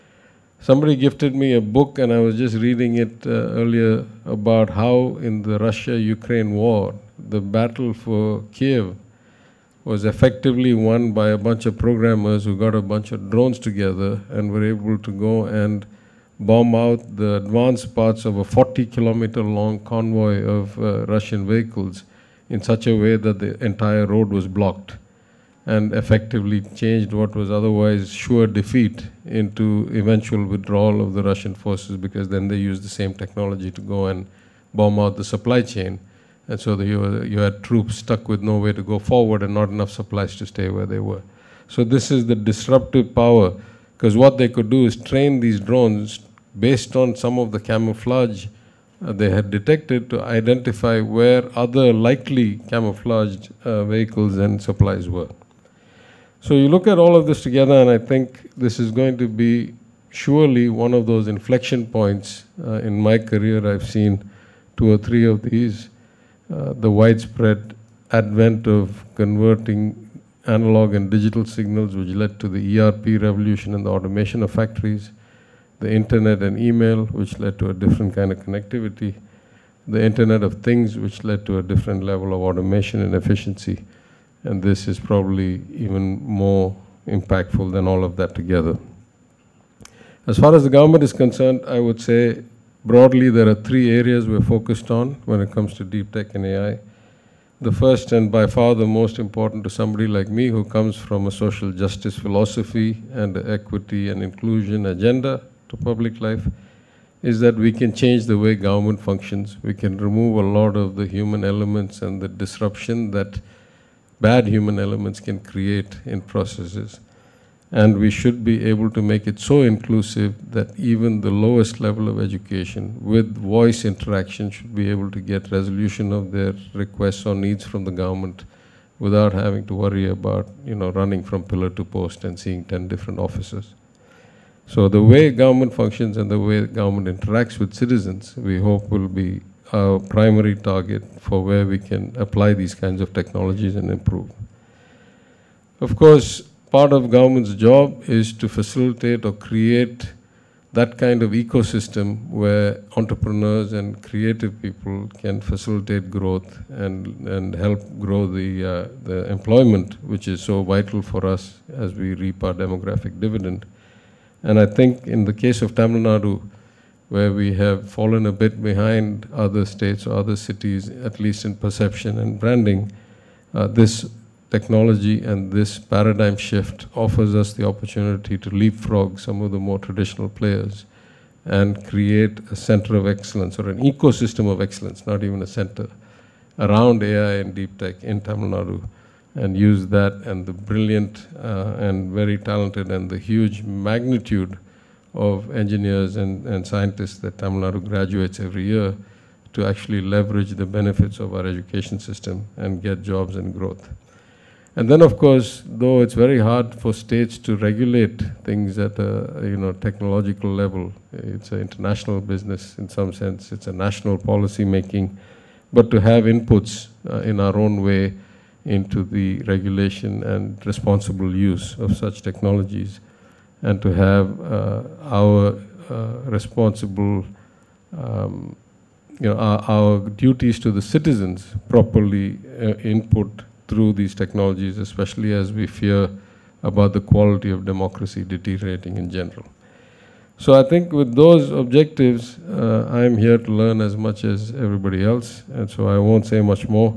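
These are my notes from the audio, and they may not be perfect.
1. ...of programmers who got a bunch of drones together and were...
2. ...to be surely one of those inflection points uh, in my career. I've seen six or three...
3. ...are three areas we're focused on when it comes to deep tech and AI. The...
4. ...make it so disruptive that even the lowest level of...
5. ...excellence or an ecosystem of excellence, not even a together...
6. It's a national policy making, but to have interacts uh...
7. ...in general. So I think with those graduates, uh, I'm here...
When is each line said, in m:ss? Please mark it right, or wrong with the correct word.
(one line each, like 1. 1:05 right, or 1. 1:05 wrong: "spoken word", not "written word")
1. 0:11 right
2. 0:59 wrong: "two", not "six"
3. 1:33 right
4. 1:59 wrong: "inclusive", not "disruptive"
5. 3:03 wrong: "center", not "together"
6. 3:33 wrong: "inputs", not "interacts"
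7. 3:58 wrong: "objectives", not "graduates".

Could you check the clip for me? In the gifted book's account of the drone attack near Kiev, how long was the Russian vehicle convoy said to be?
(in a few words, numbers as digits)
40 kilometers.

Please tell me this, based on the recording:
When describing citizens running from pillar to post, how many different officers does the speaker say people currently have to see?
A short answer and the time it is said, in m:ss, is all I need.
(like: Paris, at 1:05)
10, at 2:12.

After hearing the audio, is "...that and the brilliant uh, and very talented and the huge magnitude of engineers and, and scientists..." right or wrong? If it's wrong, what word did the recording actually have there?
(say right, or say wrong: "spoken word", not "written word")
right.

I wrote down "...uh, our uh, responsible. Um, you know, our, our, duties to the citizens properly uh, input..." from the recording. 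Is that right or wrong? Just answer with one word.
right.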